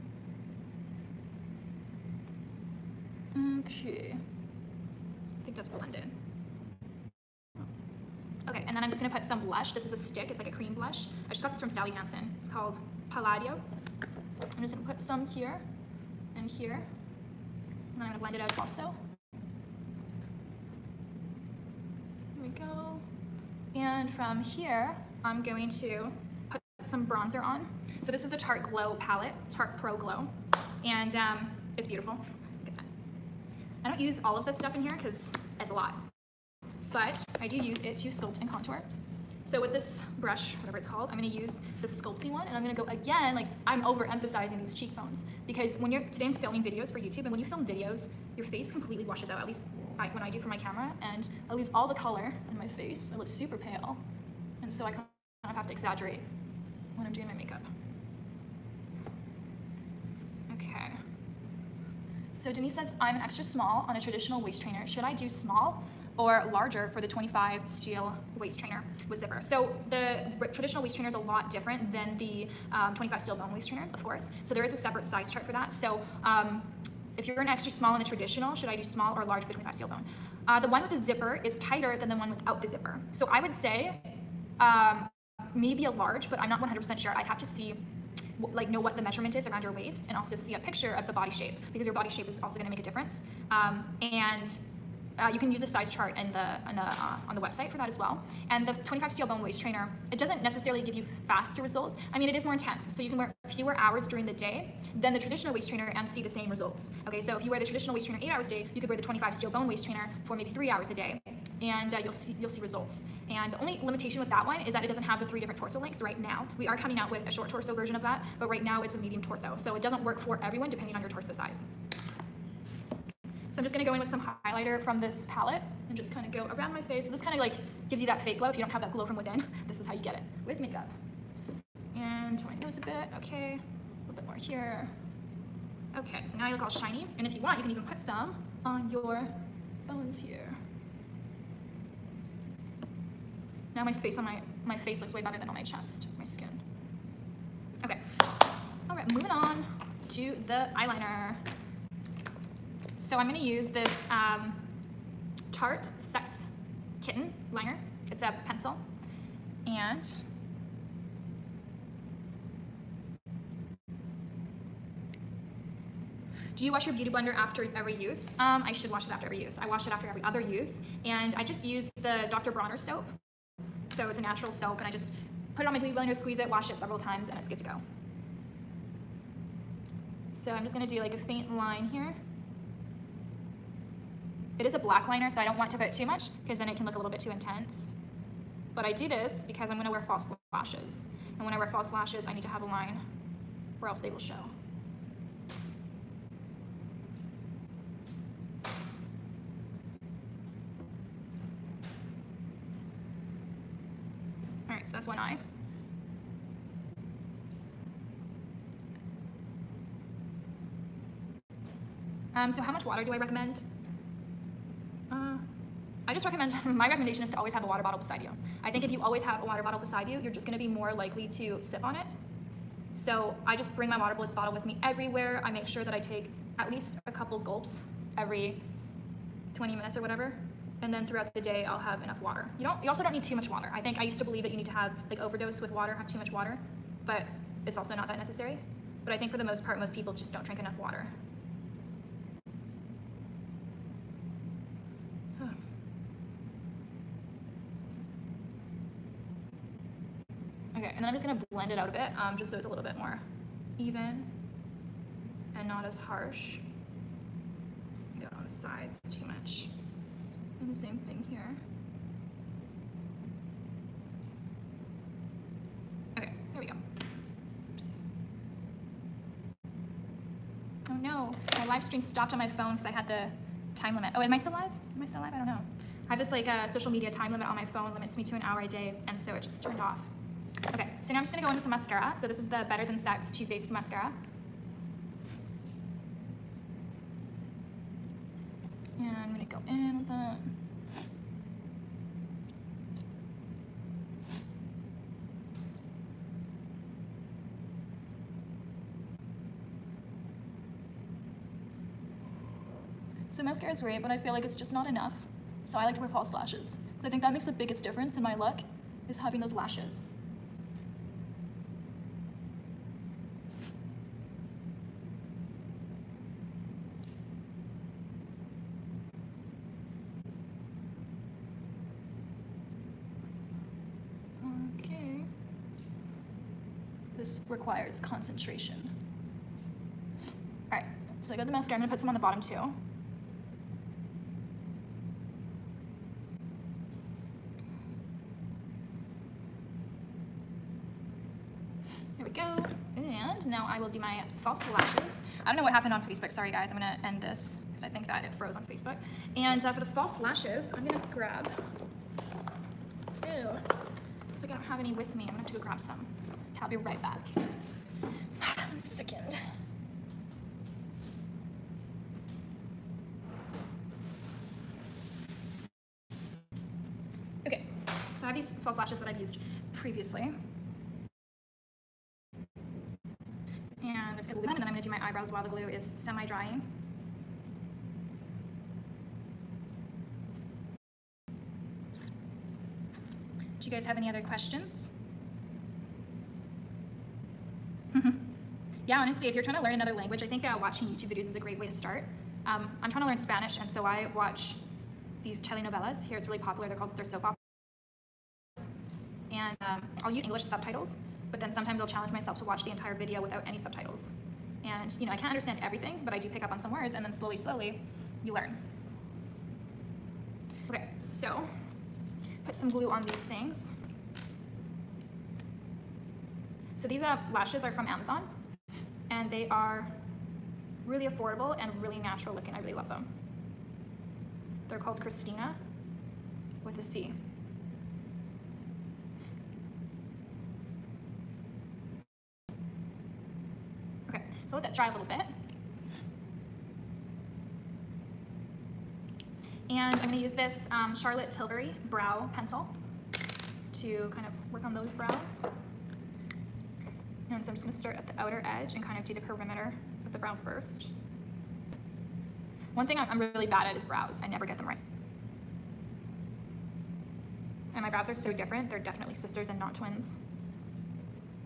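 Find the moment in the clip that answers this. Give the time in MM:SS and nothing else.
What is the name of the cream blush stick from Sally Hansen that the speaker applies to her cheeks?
00:13.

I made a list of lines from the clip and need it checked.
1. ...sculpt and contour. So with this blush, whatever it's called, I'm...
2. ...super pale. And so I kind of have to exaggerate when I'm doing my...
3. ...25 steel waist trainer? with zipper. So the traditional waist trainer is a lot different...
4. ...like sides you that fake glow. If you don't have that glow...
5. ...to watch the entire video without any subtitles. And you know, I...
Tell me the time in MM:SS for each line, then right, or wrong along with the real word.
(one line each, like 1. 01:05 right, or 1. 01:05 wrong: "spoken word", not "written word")
1. 00:38 wrong: "brush", not "blush"
2. 00:53 right
3. 01:07 right
4. 02:07 wrong: "gives", not "sides"
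5. 06:42 right.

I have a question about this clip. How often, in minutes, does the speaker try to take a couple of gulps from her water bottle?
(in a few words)
20.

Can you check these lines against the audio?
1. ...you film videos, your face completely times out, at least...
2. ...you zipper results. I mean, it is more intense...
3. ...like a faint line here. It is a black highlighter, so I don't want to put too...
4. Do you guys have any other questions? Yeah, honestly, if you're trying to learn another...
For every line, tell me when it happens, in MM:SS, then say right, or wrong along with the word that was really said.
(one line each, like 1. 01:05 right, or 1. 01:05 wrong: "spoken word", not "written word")
1. 00:47 wrong: "washes", not "times"
2. 01:40 wrong: "faster", not "zipper"
3. 03:00 wrong: "liner", not "highlighter"
4. 06:23 right.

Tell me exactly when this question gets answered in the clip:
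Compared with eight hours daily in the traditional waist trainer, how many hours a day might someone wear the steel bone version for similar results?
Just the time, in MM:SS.
01:50.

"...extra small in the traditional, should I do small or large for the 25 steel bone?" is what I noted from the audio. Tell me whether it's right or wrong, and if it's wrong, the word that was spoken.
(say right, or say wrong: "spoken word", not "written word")
right.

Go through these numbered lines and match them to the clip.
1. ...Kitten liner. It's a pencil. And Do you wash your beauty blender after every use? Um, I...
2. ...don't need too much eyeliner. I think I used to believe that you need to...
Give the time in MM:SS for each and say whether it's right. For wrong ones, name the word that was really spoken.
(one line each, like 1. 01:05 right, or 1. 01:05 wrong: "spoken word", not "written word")
1. 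02:37 right
2. 03:53 wrong: "water", not "eyeliner".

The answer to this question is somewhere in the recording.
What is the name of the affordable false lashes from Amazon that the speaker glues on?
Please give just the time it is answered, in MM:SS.
07:04.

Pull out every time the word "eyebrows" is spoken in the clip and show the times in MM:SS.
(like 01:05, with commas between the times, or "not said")
06:15.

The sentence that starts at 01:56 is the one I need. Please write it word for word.
We are coming out with a short torso version of that, but right now it's a medium torso.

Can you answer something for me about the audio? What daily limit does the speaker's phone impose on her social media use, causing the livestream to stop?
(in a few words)
An hour.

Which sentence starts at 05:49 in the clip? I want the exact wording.
And uh, for the false lashes, I'm going to grab...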